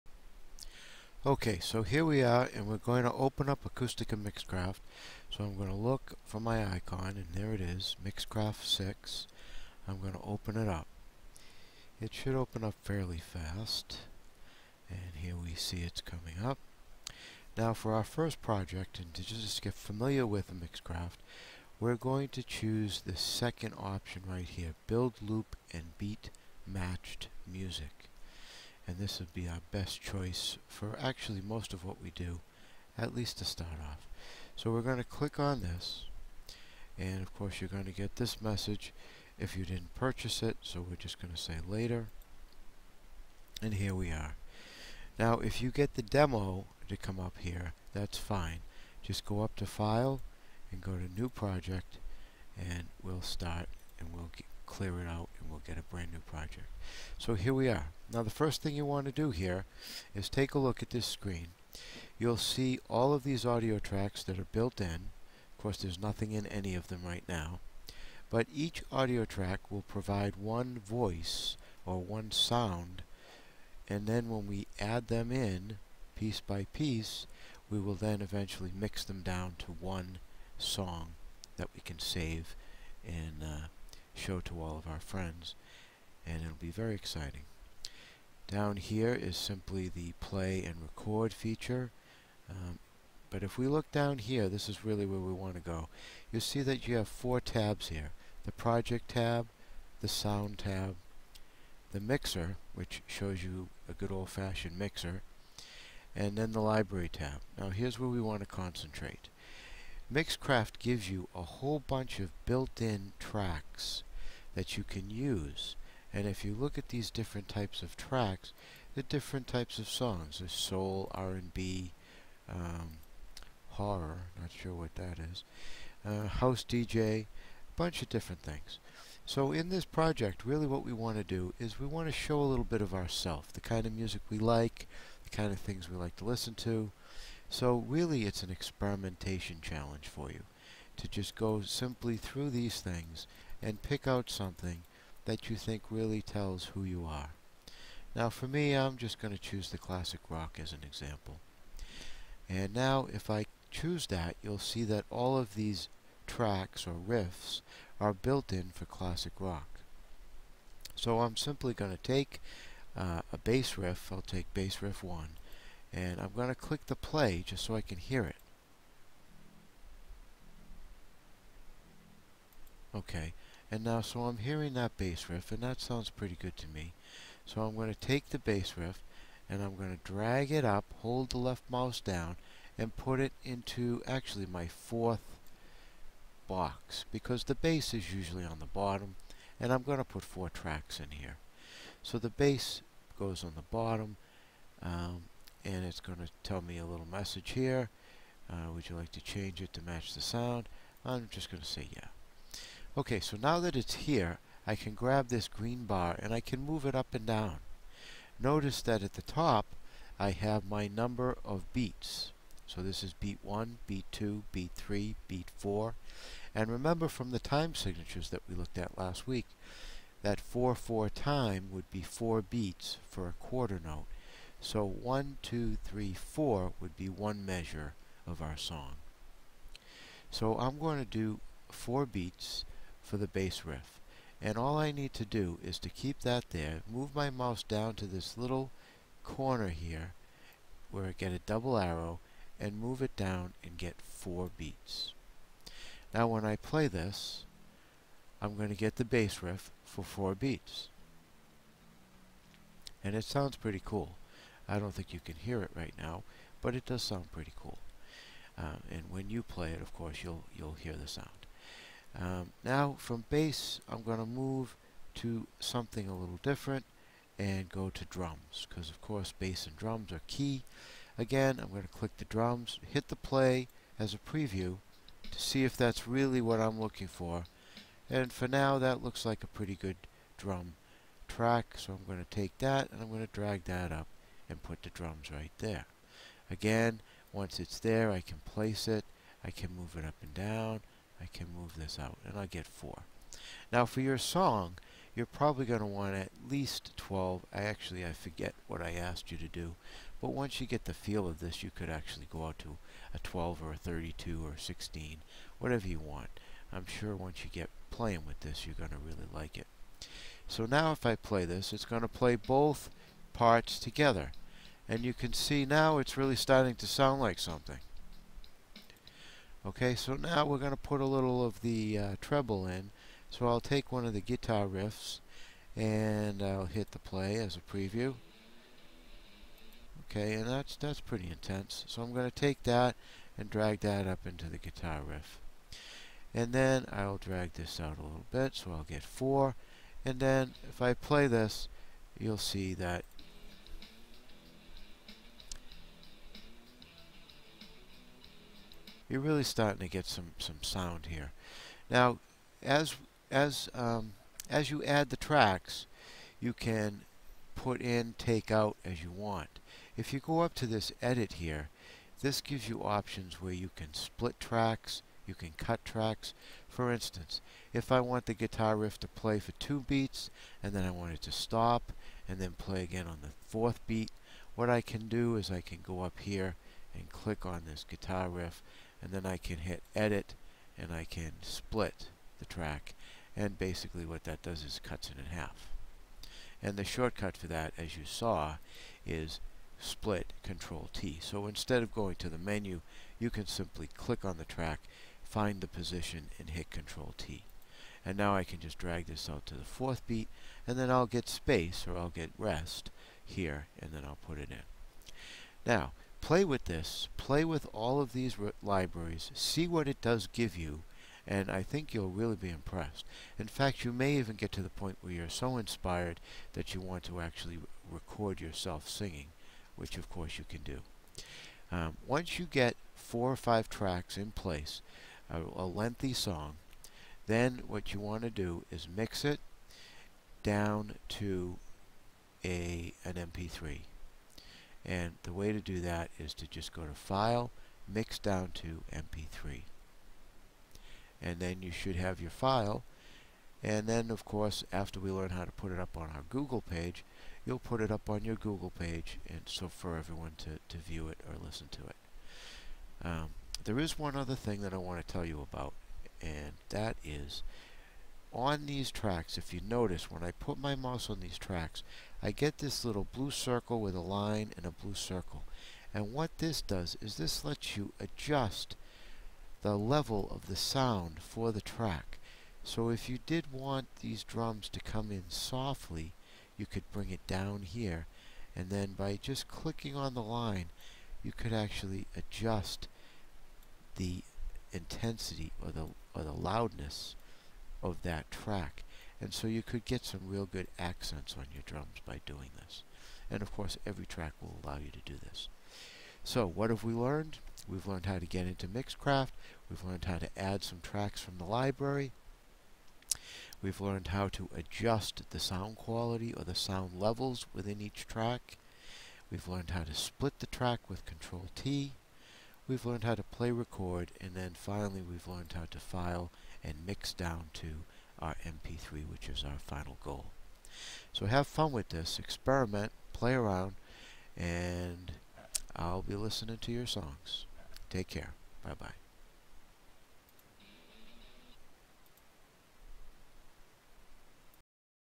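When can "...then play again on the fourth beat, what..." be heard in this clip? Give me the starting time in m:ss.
6:12.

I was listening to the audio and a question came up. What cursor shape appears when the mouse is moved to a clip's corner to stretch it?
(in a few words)
double arrow.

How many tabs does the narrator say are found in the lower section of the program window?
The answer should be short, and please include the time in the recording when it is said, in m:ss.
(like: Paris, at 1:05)
4, at 1:37.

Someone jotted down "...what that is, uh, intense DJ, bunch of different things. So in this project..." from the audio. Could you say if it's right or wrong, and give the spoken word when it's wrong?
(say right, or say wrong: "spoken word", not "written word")
wrong: "house", not "intense".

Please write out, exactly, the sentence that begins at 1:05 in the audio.
Of course there's nothing in any of them right now.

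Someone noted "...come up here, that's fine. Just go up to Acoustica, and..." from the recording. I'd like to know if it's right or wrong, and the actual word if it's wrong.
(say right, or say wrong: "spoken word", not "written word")
wrong: "File", not "Acoustica".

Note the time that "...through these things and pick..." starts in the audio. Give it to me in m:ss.
2:22.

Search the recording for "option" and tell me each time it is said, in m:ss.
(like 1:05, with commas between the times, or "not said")
0:23, 6:02.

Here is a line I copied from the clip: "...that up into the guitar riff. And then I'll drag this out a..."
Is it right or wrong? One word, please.
right.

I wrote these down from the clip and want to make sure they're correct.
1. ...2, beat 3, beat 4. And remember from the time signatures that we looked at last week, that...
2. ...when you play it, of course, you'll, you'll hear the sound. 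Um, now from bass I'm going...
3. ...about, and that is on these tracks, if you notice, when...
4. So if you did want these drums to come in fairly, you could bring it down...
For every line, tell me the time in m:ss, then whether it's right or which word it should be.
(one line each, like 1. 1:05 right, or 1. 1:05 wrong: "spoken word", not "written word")
1. 3:34 right
2. 4:19 right
3. 7:35 right
4. 7:52 wrong: "softly", not "fairly".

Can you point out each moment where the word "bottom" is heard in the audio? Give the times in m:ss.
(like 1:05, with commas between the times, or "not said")
3:08, 3:13.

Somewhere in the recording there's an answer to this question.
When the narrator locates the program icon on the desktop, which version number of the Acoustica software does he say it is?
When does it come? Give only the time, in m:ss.
0:08.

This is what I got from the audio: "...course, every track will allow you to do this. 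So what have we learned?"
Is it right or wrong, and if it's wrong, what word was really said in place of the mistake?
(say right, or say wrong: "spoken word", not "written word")
right.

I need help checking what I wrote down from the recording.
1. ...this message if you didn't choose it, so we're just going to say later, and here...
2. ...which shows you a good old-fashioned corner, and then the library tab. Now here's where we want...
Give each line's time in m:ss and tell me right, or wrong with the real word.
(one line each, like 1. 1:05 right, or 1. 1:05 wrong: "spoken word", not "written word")
1. 0:38 wrong: "purchase", not "choose"
2. 1:42 wrong: "mixer", not "corner".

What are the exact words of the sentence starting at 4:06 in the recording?
Now when I play this, I'm going to get the bass riff for four beats.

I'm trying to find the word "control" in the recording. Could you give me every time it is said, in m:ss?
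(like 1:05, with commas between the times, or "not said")
6:30, 6:36, 8:31.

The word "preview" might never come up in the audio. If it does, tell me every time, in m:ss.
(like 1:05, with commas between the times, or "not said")
4:34, 5:27.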